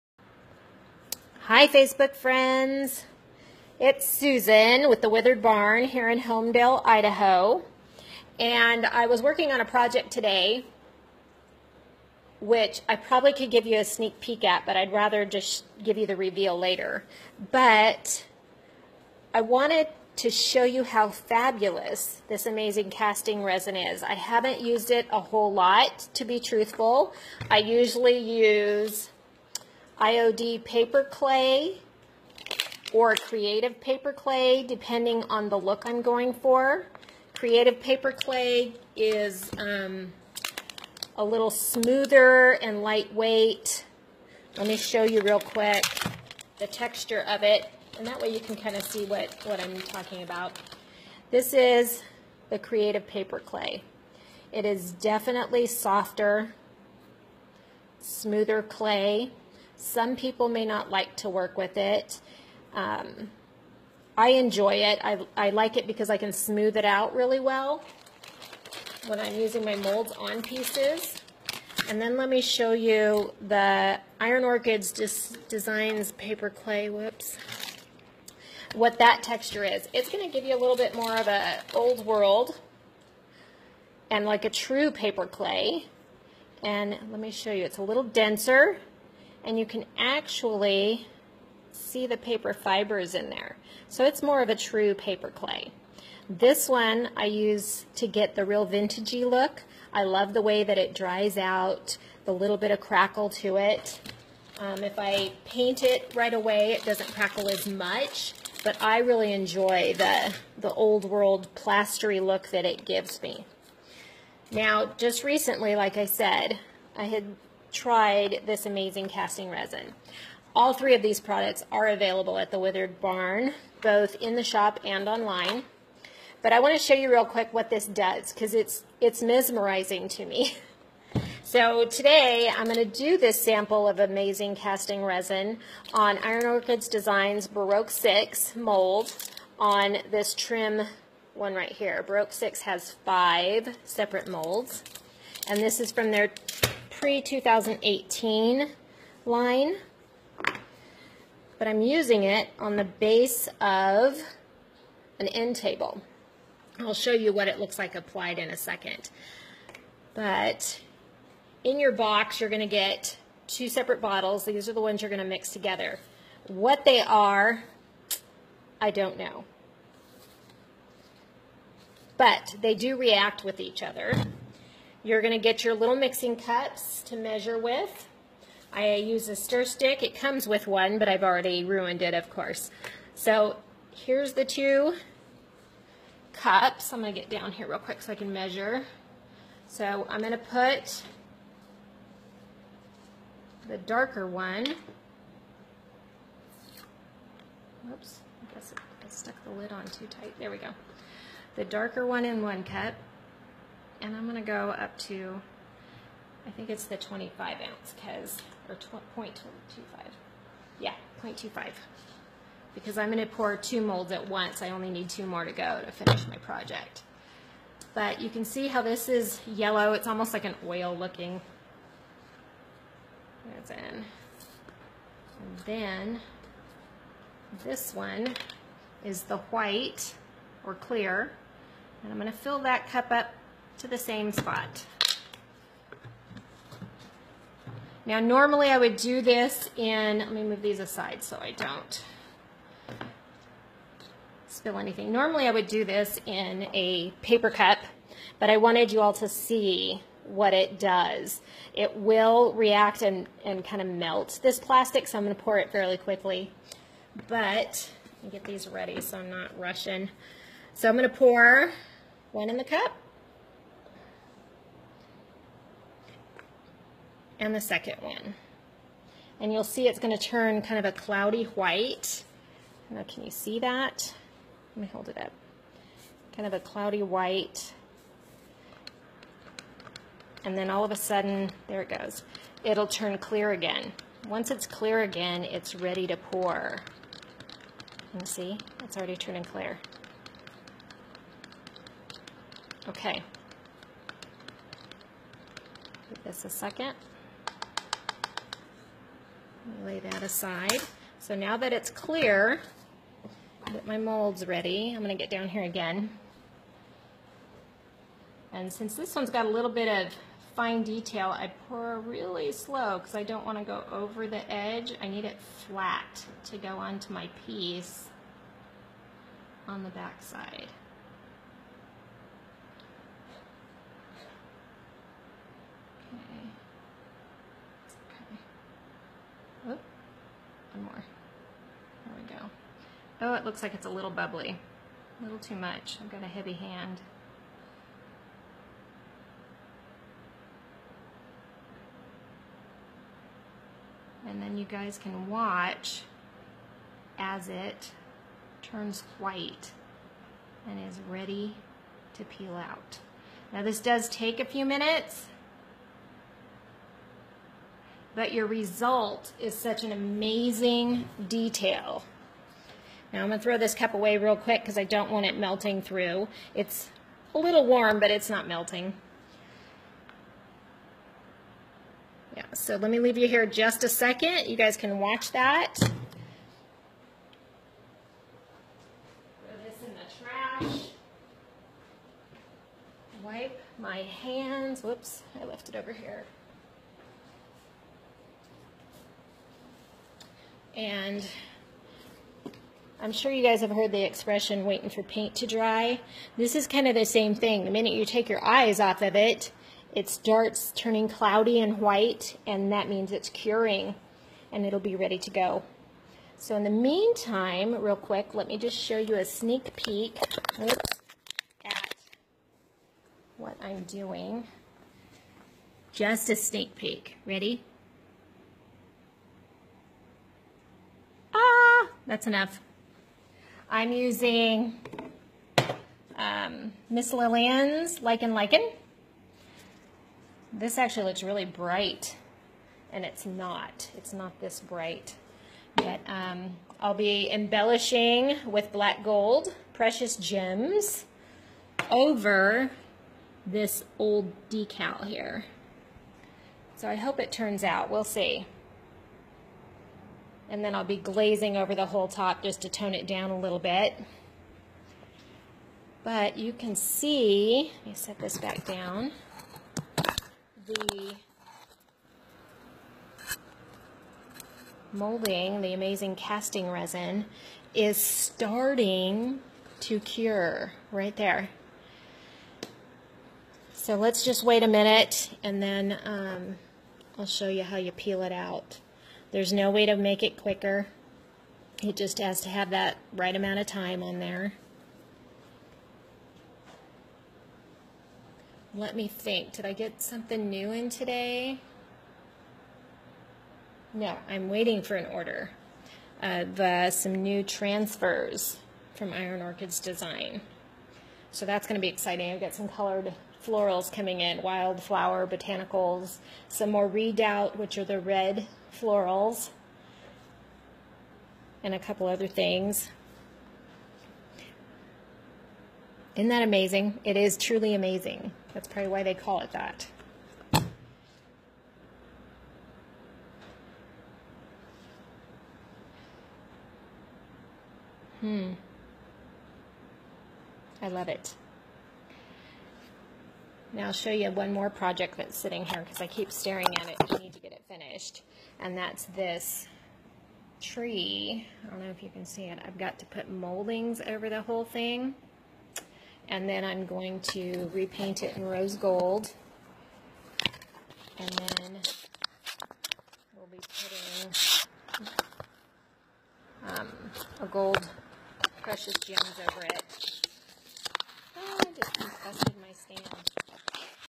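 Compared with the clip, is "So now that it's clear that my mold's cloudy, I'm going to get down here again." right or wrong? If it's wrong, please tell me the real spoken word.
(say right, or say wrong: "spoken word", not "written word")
wrong: "ready", not "cloudy".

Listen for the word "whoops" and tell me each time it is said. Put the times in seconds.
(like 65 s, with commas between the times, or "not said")
76 s, 384 s.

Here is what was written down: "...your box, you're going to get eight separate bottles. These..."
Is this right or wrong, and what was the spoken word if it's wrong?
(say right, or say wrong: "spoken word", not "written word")
wrong: "two", not "eight".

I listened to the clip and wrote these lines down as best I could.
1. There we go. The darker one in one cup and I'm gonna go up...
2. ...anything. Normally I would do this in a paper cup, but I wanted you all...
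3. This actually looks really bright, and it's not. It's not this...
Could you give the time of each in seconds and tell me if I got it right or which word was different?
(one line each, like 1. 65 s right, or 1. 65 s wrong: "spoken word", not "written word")
1. 200 s right
2. 244 s right
3. 430 s right.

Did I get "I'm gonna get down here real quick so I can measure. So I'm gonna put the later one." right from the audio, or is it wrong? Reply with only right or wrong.
wrong.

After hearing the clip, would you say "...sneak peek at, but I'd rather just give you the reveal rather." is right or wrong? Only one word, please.
wrong.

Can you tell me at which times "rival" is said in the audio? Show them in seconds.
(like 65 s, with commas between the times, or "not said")
not said.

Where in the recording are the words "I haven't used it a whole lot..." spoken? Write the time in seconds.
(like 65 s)
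24 s.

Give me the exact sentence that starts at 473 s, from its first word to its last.
So let's just wait a minute and then um, I'll show you how you peel it out.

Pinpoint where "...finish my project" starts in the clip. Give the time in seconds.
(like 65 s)
215 s.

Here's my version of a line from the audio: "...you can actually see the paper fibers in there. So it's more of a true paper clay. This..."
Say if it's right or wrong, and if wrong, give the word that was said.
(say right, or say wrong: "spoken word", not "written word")
right.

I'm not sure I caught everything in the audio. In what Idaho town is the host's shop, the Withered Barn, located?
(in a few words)
Homedale.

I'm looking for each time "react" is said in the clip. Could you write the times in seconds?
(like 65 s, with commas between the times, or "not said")
172 s, 252 s.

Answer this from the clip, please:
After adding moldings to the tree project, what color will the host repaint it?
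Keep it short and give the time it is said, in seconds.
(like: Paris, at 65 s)
Rose gold, at 548 s.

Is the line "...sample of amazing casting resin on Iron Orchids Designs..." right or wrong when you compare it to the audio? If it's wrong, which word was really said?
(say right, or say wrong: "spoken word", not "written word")
right.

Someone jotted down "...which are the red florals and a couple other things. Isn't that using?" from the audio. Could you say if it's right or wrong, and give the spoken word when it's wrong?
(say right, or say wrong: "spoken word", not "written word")
wrong: "amazing", not "using".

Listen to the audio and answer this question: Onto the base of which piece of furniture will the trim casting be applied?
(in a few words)
An end table.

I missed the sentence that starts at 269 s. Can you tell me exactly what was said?
And you'll see it's going to turn kind of a cloudy white.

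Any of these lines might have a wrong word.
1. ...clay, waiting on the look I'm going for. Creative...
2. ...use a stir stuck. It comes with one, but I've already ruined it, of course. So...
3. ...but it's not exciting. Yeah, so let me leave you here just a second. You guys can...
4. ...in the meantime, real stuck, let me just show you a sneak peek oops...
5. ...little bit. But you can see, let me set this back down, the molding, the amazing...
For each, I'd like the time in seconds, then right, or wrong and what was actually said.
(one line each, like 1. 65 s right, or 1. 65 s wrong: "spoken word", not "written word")
1. 34 s wrong: "depending", not "waiting"
2. 178 s wrong: "stick", not "stuck"
3. 367 s wrong: "melting", not "exciting"
4. 406 s wrong: "quick", not "stuck"
5. 453 s right.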